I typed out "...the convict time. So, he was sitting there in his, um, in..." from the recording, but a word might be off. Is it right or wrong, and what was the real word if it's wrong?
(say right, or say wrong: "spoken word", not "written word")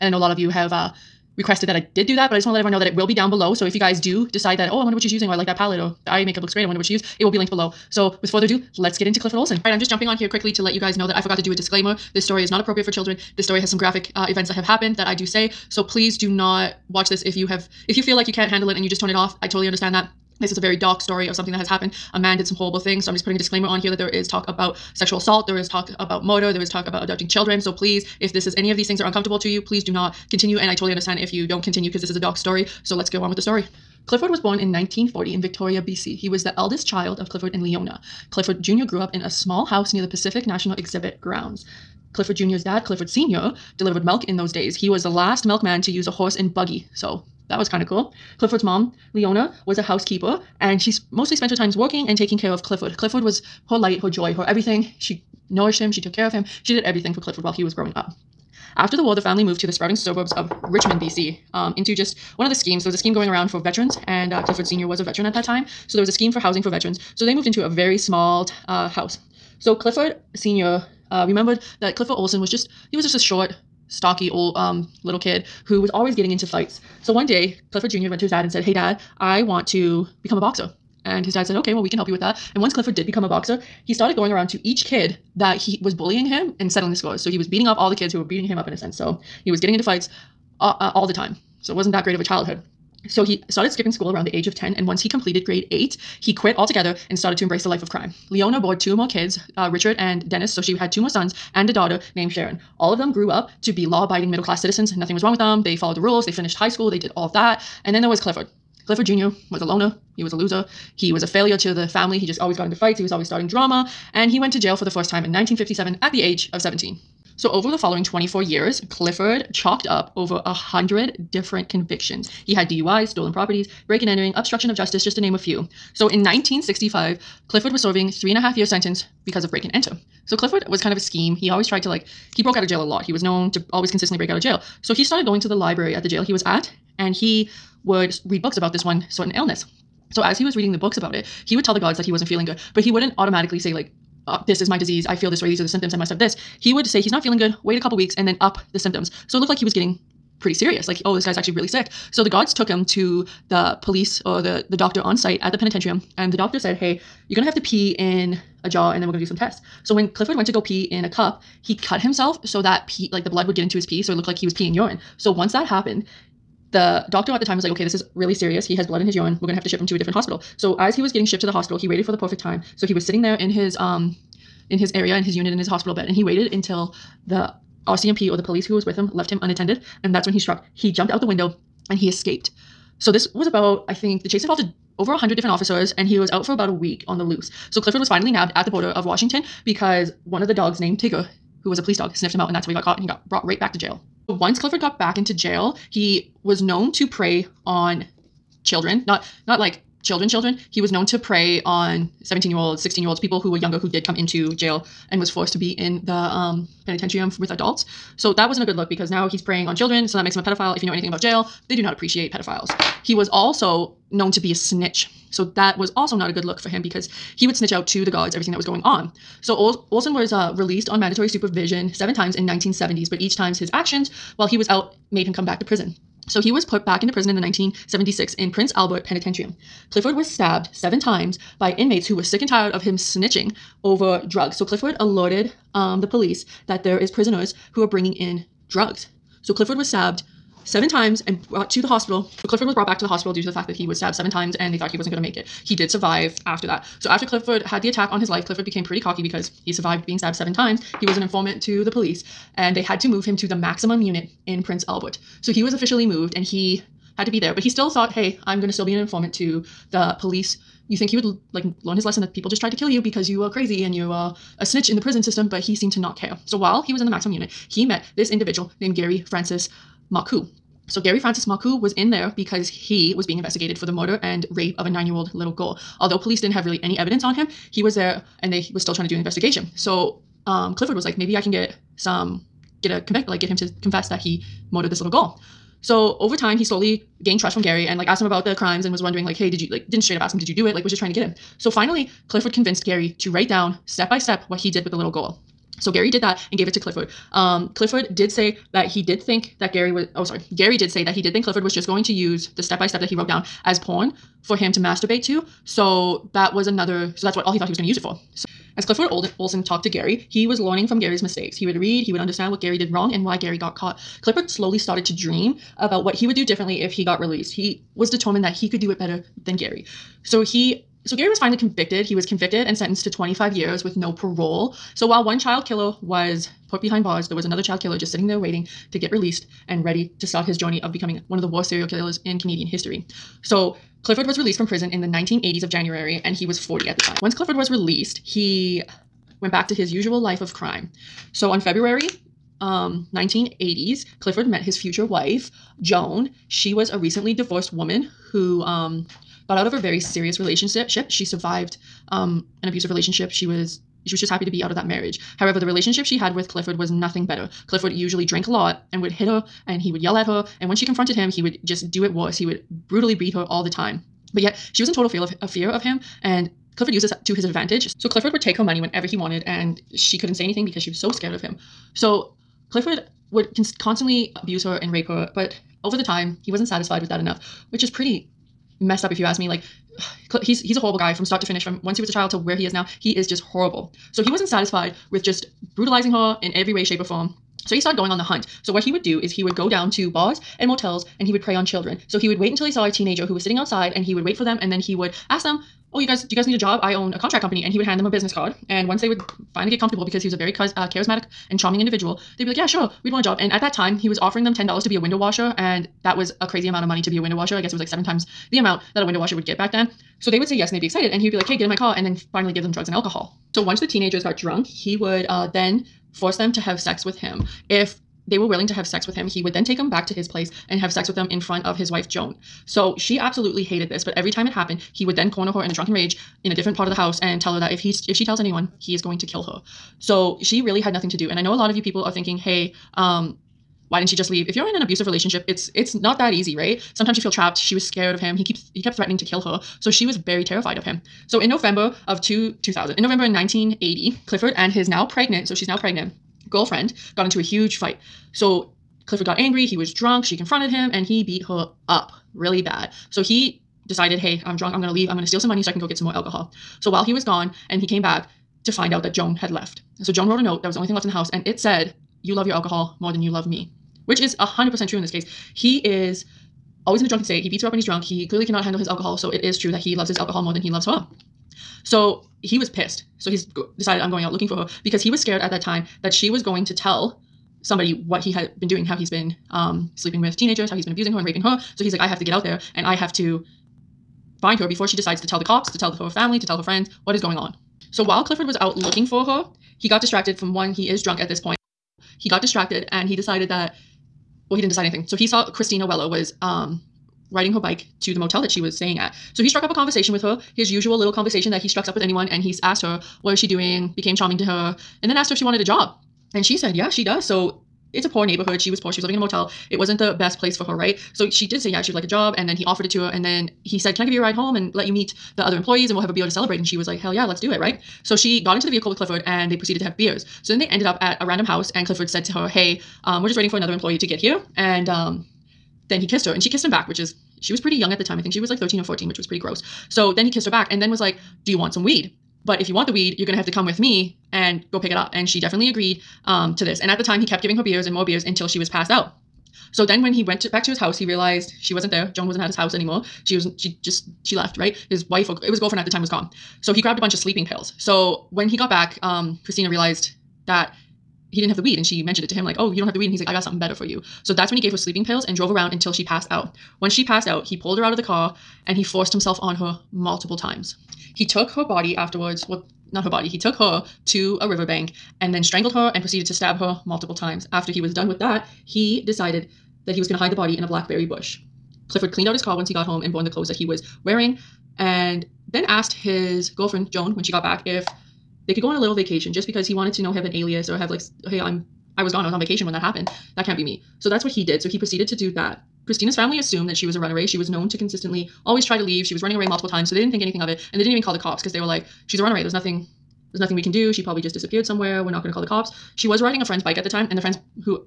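wrong: "perfect", not "convict".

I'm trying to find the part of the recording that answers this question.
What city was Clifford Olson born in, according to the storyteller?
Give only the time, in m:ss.
0:35.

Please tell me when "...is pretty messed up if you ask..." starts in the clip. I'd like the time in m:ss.
6:17.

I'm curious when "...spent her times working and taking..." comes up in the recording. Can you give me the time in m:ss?
0:51.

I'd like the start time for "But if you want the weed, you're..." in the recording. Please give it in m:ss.
8:52.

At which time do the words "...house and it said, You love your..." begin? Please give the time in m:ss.
7:41.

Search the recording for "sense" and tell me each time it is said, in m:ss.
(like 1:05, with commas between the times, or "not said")
1:28.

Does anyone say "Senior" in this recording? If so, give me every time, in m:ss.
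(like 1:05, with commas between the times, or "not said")
1:04, 1:10.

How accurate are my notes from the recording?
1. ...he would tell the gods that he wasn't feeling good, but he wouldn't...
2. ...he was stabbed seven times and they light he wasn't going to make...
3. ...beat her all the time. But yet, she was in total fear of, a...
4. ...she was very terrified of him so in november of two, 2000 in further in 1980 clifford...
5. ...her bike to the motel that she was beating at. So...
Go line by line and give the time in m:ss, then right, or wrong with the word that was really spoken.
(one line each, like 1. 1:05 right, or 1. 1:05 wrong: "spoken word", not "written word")
1. 2:21 right
2. 4:03 wrong: "thought", not "light"
3. 6:03 right
4. 7:19 wrong: "november", not "further"
5. 8:17 wrong: "staying", not "beating".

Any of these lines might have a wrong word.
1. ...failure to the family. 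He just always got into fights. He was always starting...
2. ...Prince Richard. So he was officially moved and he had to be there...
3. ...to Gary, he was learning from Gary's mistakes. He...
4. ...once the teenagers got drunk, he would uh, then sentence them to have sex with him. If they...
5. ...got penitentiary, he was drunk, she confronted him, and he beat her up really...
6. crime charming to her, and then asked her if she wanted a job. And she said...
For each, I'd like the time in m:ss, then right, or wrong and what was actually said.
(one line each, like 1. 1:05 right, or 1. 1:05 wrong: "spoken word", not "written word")
1. 1:51 right
2. 4:14 wrong: "Albert", not "Richard"
3. 5:09 right
4. 6:53 wrong: "force", not "sentence"
5. 7:29 wrong: "angry", not "penitentiary"
6. 8:23 wrong: "became", not "crime".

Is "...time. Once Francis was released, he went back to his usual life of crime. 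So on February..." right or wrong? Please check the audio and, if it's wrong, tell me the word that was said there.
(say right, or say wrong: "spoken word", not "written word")
wrong: "Clifford", not "Francis".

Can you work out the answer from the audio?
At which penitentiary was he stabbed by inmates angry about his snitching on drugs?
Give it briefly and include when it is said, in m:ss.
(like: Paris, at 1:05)
Prince Albert Penitentiary, at 3:48.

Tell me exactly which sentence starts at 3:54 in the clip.
So Clifford alerted um, the police that there is prisoners who are bringing in drugs.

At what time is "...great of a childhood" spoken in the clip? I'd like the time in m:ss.
1:32.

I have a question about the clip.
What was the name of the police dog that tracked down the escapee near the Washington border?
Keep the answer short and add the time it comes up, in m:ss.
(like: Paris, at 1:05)
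Tigger, at 3:10.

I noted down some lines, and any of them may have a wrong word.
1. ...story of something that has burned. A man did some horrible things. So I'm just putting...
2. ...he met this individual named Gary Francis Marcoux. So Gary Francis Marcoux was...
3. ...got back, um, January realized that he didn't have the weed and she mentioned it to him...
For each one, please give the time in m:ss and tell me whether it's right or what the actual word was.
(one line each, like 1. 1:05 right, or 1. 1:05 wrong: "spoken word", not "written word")
1. 0:21 wrong: "happened", not "burned"
2. 4:27 right
3. 9:08 wrong: "Christina", not "January".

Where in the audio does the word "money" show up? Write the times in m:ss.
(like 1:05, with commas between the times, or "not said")
6:08, 6:46, 7:35.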